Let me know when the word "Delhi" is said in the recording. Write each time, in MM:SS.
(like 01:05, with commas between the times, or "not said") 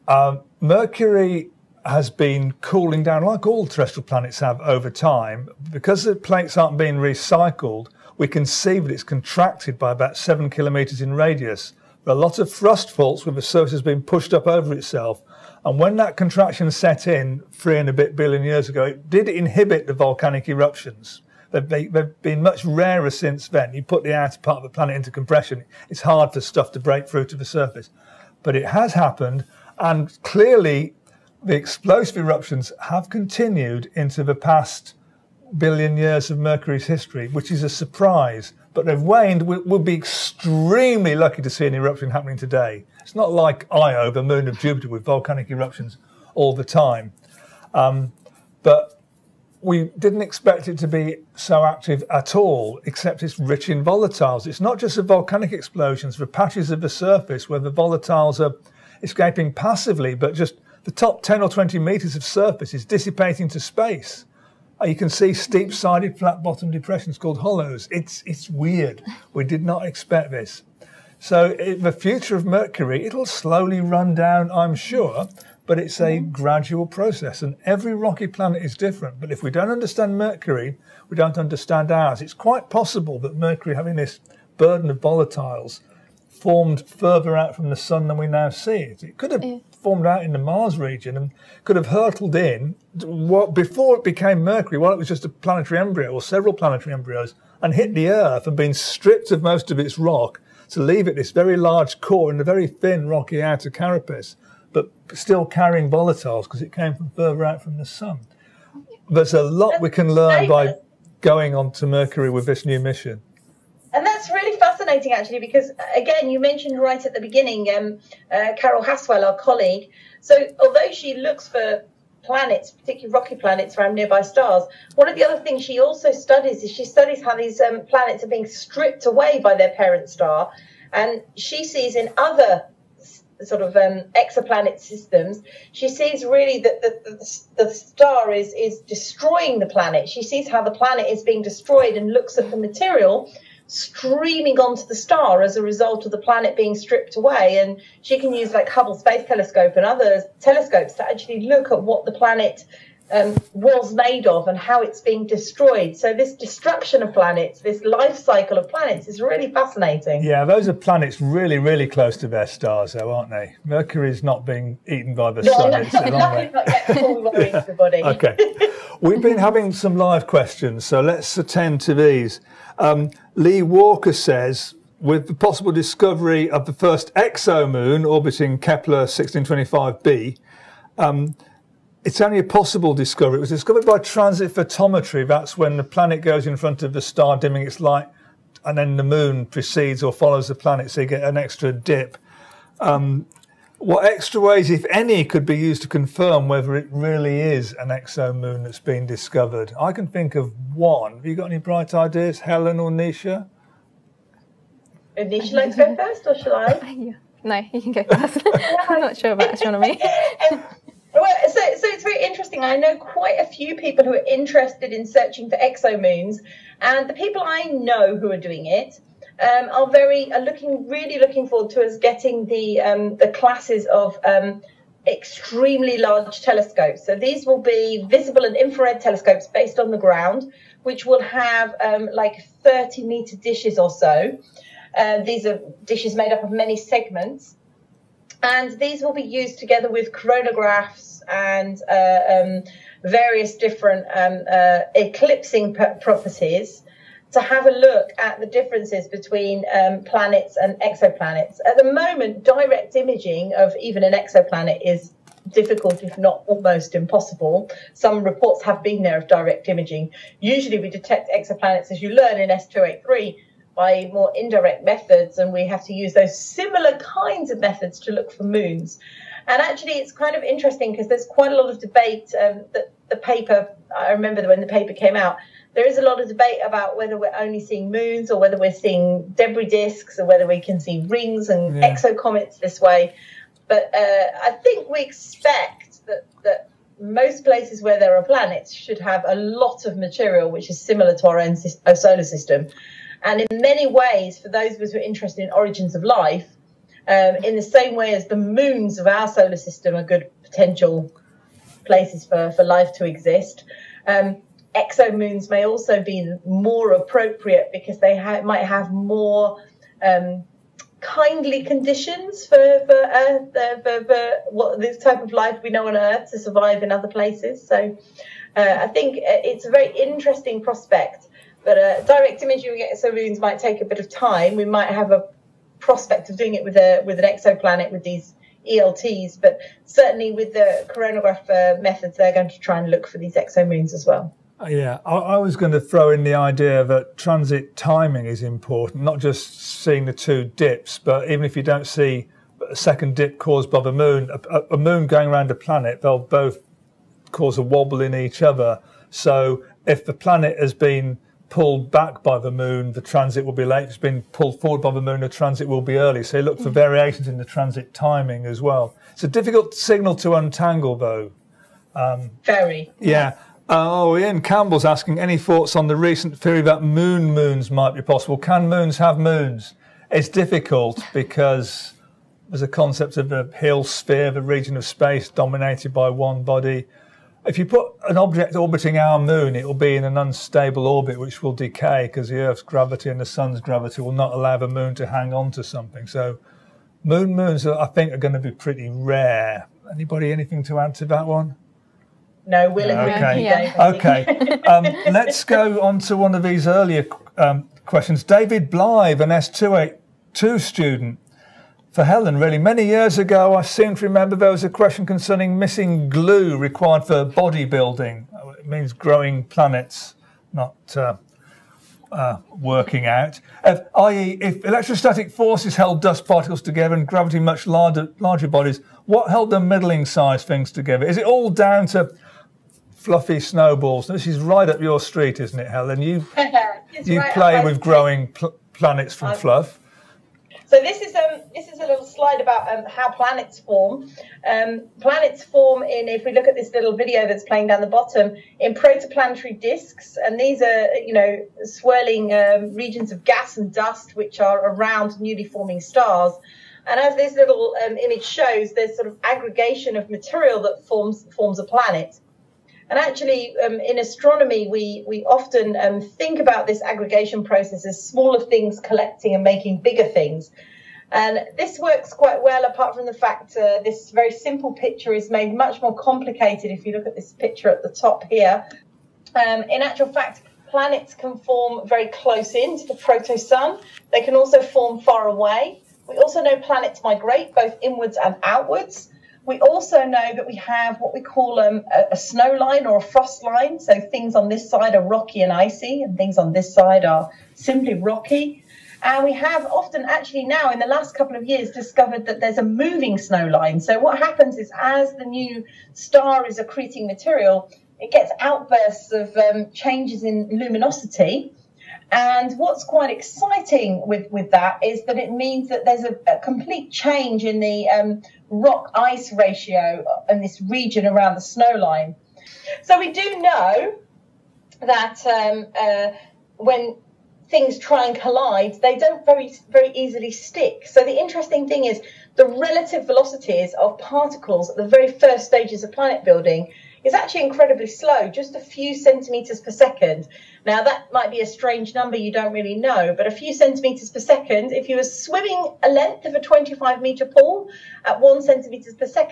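not said.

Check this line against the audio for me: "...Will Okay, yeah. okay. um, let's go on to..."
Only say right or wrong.
right.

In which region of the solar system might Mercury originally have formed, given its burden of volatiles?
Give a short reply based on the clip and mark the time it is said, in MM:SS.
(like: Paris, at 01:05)
Mars region, at 01:30.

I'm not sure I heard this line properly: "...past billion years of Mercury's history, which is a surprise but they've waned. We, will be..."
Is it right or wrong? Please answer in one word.
right.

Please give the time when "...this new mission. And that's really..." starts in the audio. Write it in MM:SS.
01:52.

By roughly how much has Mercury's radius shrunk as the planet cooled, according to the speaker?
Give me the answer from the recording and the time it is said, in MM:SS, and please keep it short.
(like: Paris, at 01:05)
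7 kilometers, at 00:10.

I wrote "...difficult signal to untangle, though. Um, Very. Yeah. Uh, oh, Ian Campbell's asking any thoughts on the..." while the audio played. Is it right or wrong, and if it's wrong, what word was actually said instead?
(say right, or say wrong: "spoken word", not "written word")
right.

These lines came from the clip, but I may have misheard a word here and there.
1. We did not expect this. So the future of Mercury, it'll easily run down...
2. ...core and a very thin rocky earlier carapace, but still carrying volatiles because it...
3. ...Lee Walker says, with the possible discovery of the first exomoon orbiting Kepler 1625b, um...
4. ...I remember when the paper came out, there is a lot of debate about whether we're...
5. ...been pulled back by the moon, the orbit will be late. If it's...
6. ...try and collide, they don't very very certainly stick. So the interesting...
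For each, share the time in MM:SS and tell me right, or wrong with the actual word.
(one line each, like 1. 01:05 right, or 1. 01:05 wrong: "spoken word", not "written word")
1. 01:09 wrong: "slowly", not "easily"
2. 01:41 wrong: "outer", not "earlier"
3. 02:53 right
4. 04:33 right
5. 05:50 wrong: "transit", not "orbit"
6. 08:37 wrong: "easily", not "certainly".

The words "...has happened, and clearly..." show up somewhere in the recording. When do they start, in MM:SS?
00:28.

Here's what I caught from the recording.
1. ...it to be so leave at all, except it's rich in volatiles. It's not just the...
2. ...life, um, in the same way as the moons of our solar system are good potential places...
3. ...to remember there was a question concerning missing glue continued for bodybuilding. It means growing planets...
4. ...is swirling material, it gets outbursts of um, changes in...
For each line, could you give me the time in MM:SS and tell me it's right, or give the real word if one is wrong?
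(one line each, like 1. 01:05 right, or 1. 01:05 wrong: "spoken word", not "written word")
1. 00:50 wrong: "active", not "leave"
2. 04:56 right
3. 06:43 wrong: "required", not "continued"
4. 08:16 wrong: "accreting", not "swirling".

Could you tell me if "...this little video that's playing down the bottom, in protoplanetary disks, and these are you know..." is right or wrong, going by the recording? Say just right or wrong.
right.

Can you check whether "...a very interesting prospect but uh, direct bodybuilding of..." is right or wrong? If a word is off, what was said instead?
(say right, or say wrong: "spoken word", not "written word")
wrong: "imaging", not "bodybuilding".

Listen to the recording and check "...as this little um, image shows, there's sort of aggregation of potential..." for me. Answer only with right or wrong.
wrong.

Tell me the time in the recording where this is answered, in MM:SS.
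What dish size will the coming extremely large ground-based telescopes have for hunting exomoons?
03:52.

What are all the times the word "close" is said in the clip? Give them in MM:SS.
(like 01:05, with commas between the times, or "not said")
02:41, 07:52.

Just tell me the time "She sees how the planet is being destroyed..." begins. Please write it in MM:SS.
02:20.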